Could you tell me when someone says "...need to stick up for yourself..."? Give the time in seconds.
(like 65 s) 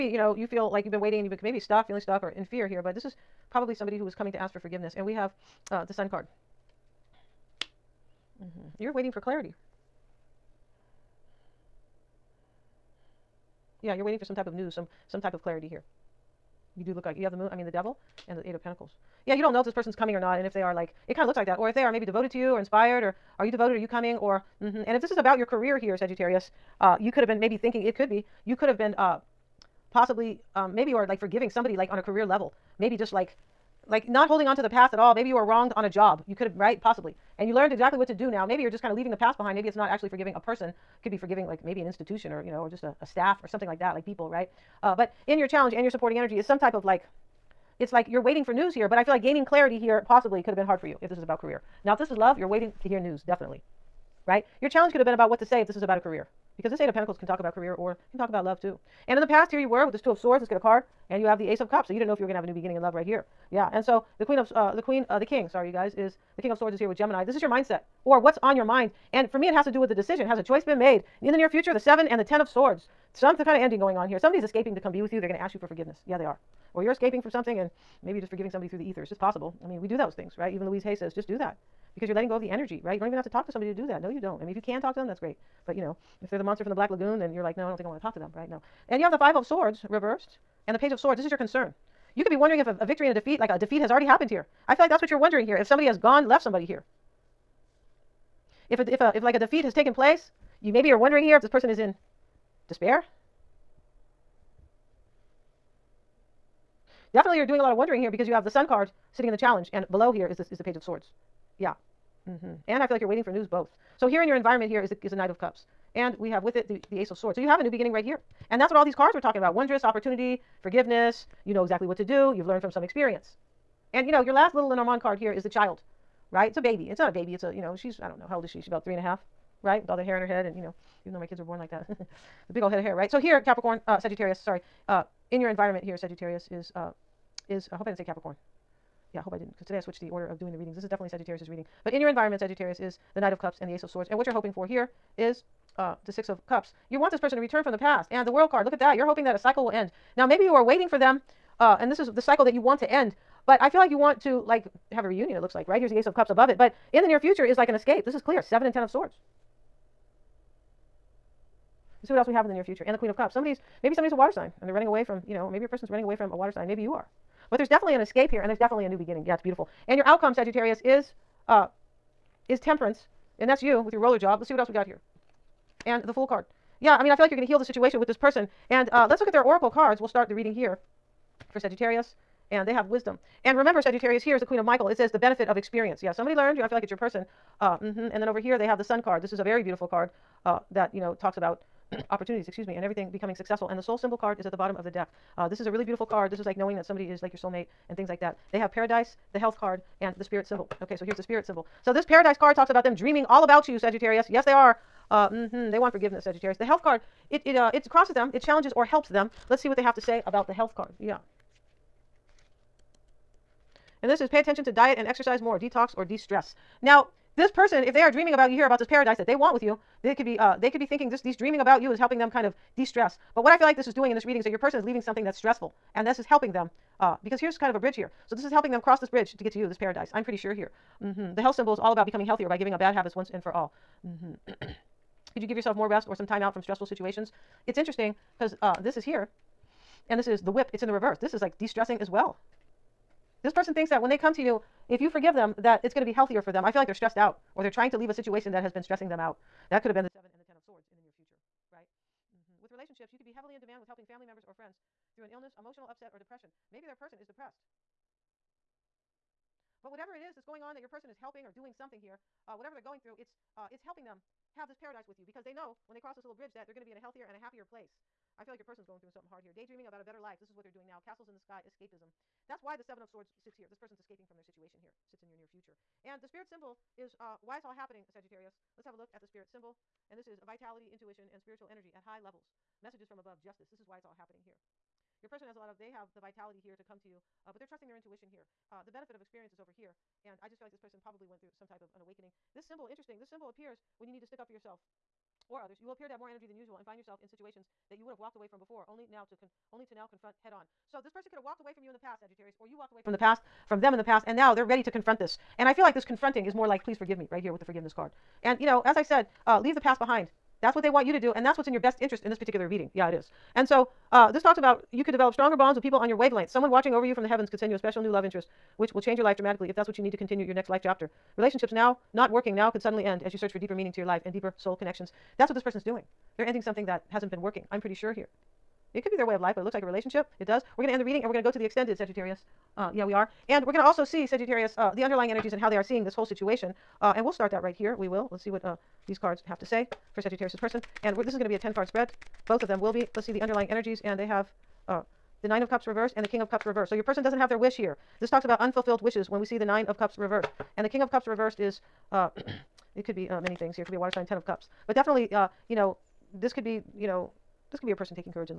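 294 s.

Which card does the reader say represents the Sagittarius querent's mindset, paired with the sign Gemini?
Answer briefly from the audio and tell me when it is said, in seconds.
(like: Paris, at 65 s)
King of Swords, at 66 s.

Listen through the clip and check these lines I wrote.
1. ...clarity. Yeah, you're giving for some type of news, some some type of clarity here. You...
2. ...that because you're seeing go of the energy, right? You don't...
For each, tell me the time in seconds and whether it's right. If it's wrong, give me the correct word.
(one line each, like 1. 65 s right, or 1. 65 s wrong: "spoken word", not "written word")
1. 9 s wrong: "waiting", not "giving"
2. 81 s wrong: "letting", not "seeing".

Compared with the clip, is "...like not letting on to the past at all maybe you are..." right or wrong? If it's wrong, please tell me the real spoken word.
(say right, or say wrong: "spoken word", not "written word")
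wrong: "holding", not "letting".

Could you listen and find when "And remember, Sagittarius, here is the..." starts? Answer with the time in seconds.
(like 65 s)
183 s.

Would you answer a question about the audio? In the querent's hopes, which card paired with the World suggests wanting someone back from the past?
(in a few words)
Six of Cups.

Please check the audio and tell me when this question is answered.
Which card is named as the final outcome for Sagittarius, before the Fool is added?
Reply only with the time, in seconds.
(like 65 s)
172 s.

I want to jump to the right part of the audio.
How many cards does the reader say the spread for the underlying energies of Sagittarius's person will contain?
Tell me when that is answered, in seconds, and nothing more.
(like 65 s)
341 s.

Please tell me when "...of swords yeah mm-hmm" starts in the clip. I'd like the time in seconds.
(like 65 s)
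110 s.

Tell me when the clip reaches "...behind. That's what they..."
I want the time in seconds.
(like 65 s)
309 s.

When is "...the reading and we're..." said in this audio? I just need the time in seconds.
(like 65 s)
331 s.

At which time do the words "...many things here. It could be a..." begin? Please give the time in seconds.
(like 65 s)
353 s.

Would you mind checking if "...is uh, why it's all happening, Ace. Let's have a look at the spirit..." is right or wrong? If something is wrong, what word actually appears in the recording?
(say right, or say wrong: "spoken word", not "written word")
wrong: "Sagittarius", not "Ace".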